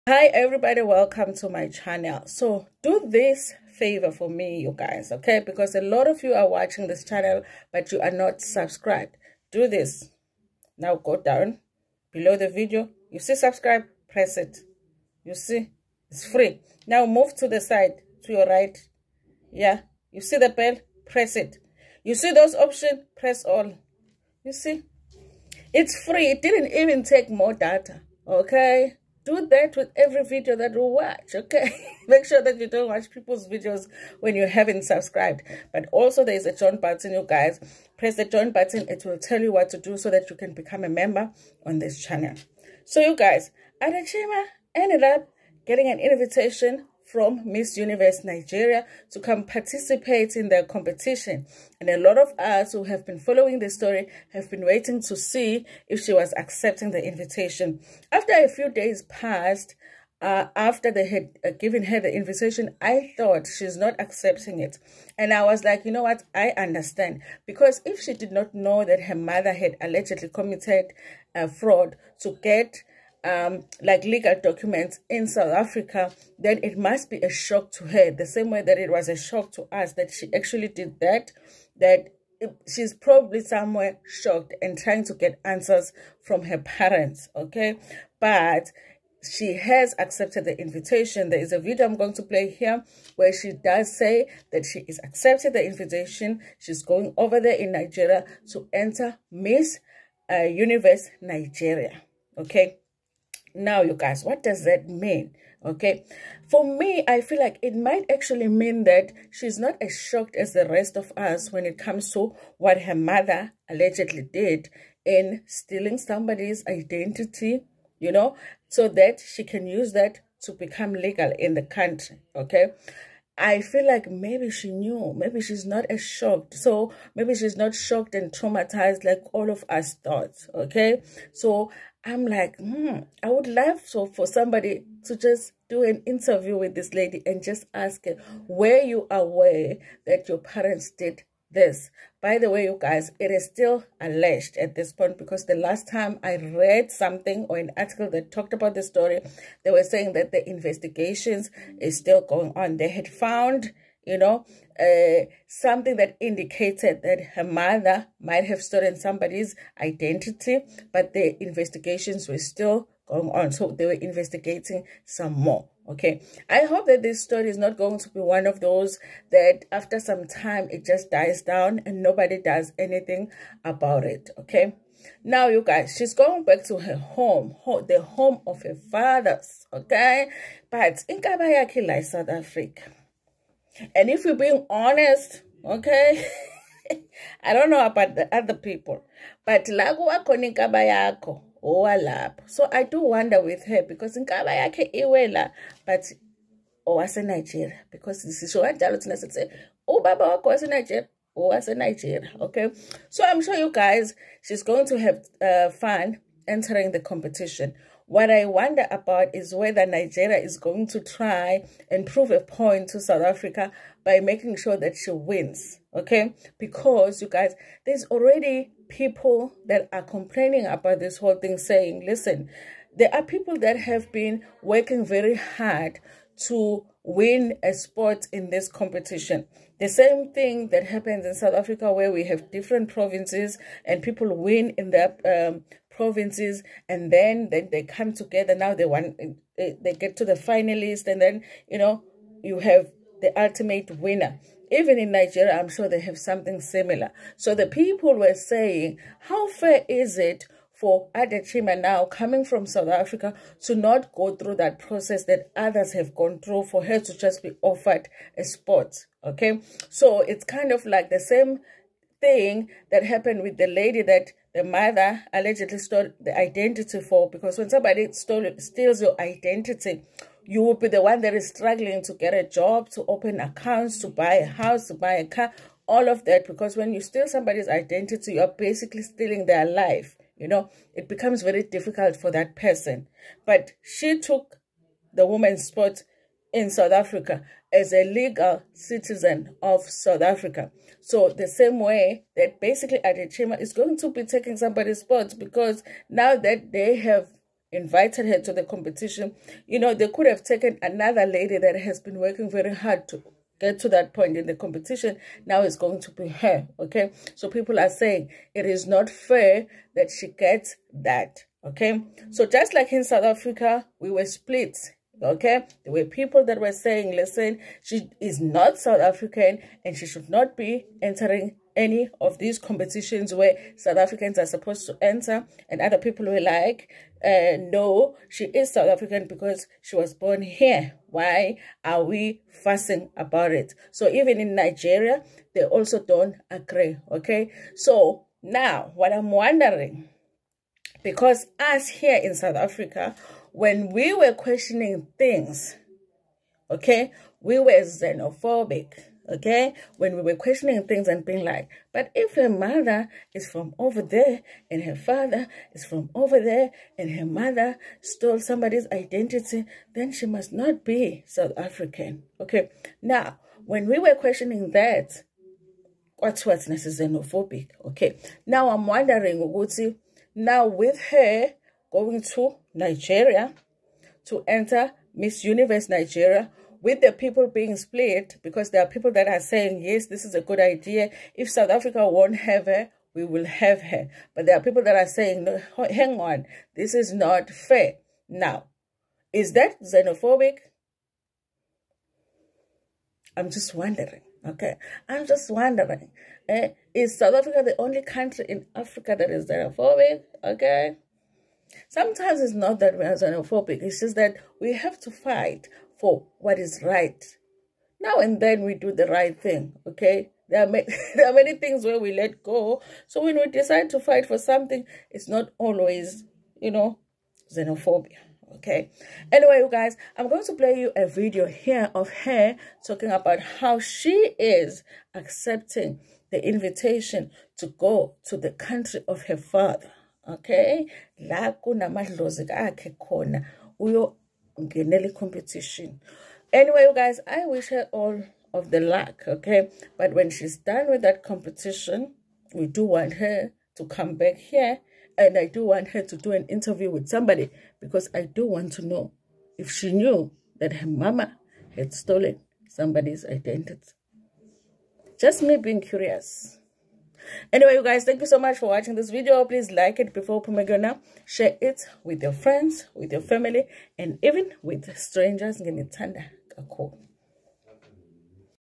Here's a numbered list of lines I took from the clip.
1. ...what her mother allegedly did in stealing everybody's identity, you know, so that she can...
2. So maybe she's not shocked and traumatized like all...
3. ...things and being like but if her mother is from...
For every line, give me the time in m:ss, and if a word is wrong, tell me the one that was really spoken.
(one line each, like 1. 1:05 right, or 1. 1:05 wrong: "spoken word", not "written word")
1. 1:52 wrong: "somebody", not "everybody"
2. 2:06 right
3. 5:50 right.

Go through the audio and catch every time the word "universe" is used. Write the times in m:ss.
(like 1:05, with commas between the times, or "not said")
0:47, 1:40, 6:15.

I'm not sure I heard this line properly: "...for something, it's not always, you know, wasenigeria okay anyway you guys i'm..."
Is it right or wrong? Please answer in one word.
wrong.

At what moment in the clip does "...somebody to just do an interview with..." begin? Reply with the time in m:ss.
2:14.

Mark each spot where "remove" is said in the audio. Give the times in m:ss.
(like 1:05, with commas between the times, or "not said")
not said.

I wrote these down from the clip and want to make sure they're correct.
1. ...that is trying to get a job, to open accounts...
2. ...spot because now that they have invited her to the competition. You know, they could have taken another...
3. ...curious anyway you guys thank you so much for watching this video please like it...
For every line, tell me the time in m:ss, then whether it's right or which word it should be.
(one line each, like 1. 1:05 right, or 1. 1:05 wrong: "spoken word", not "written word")
1. 4:31 wrong: "struggling", not "trying"
2. 4:55 right
3. 7:35 right.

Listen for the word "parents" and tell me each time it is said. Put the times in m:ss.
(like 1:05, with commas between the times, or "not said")
1:26, 2:20.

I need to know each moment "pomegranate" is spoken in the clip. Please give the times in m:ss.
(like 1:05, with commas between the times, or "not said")
7:40.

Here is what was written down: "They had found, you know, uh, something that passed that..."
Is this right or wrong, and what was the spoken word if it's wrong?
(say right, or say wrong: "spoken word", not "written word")
wrong: "indicated", not "passed".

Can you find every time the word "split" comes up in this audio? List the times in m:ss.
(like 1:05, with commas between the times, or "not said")
5:14, 6:17.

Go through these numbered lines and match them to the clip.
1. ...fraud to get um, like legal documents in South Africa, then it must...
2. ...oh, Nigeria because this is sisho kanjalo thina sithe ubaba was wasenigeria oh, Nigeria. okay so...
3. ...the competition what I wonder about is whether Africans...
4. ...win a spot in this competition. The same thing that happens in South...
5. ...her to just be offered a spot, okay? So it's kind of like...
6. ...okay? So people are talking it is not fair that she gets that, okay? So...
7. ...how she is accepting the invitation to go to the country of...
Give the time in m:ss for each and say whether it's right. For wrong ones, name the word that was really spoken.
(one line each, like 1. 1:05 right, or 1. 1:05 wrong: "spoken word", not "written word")
1. 1:11 right
2. 3:16 right
3. 3:26 wrong: "Nigeria", not "Africans"
4. 3:47 right
5. 4:16 right
6. 5:06 wrong: "saying", not "talking"
7. 7:03 right.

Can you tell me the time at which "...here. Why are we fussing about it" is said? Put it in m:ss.
5:30.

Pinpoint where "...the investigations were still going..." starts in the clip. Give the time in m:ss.
2:41.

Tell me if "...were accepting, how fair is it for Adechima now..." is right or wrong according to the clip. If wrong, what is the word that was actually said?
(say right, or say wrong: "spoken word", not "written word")
wrong: "saying", not "accepting".